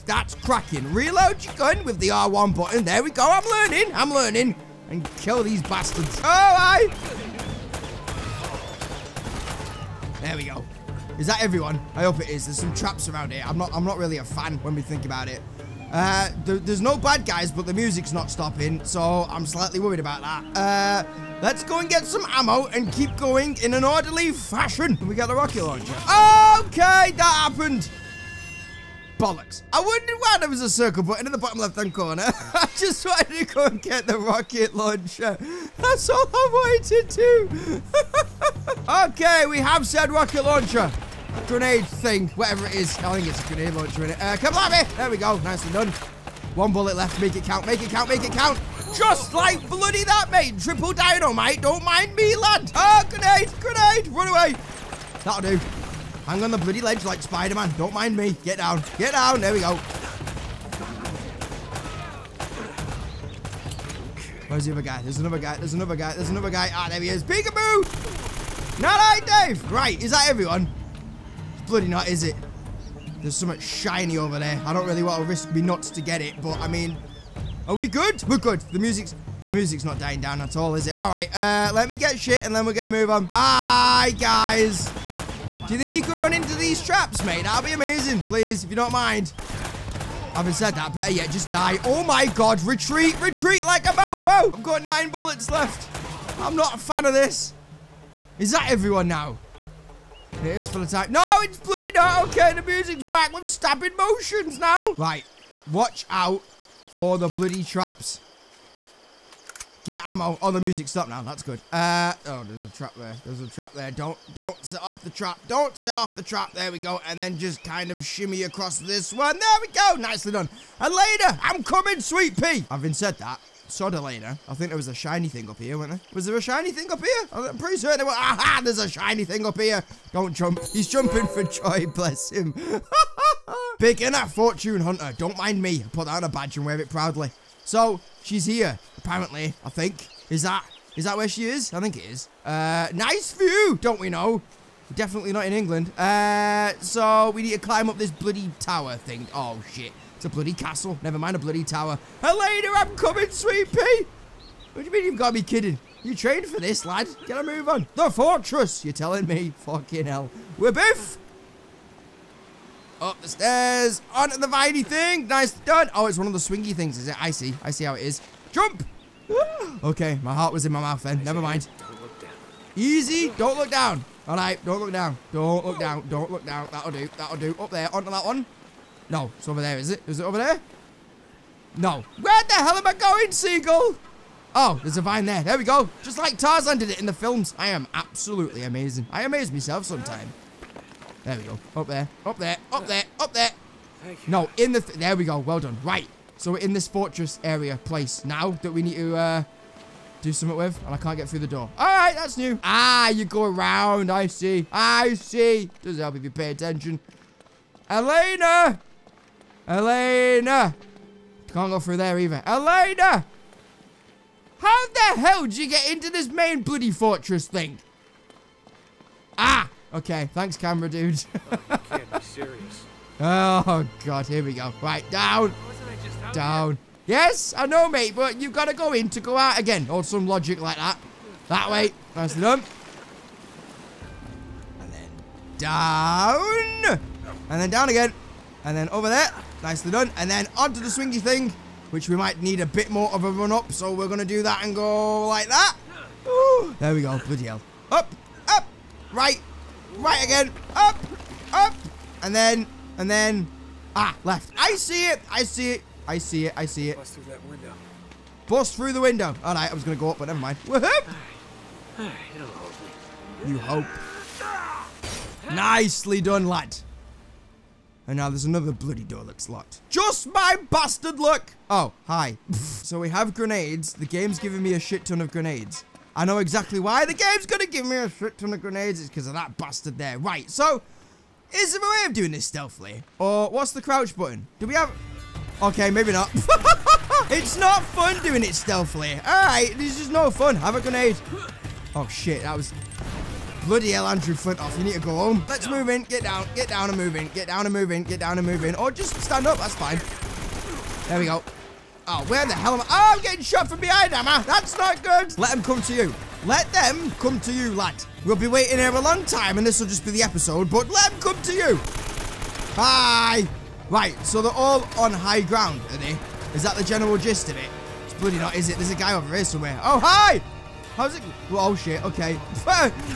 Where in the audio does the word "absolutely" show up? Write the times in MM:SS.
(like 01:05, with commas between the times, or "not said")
03:07.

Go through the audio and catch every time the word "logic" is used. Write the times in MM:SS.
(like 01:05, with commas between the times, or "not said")
03:50.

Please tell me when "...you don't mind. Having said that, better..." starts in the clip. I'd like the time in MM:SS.
01:28.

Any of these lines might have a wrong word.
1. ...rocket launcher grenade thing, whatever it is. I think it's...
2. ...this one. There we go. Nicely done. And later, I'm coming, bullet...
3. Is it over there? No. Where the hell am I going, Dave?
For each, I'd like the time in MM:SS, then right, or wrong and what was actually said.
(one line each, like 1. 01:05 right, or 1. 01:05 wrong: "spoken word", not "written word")
1. 00:40 right
2. 01:58 wrong: "sweet", not "bullet"
3. 03:00 wrong: "Seagull", not "Dave".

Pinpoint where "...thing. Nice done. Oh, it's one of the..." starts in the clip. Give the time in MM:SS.
02:44.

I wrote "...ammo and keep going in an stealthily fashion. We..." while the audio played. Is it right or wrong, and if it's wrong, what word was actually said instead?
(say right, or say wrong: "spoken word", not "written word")
wrong: "orderly", not "stealthily".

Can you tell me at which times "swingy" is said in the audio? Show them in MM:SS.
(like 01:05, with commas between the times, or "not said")
02:46, 04:00.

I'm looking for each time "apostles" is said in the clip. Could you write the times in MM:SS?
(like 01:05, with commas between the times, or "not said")
not said.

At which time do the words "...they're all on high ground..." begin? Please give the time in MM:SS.
05:14.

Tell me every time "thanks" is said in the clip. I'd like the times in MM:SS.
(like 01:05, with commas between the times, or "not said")
03:40.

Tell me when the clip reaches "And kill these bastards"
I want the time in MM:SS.
00:04.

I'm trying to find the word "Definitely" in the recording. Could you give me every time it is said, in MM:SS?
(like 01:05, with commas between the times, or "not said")
02:24.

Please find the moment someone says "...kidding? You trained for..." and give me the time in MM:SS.
02:35.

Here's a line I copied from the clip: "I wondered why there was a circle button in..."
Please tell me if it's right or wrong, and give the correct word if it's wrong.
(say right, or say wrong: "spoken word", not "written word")
right.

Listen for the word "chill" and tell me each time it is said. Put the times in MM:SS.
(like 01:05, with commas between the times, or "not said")
not said.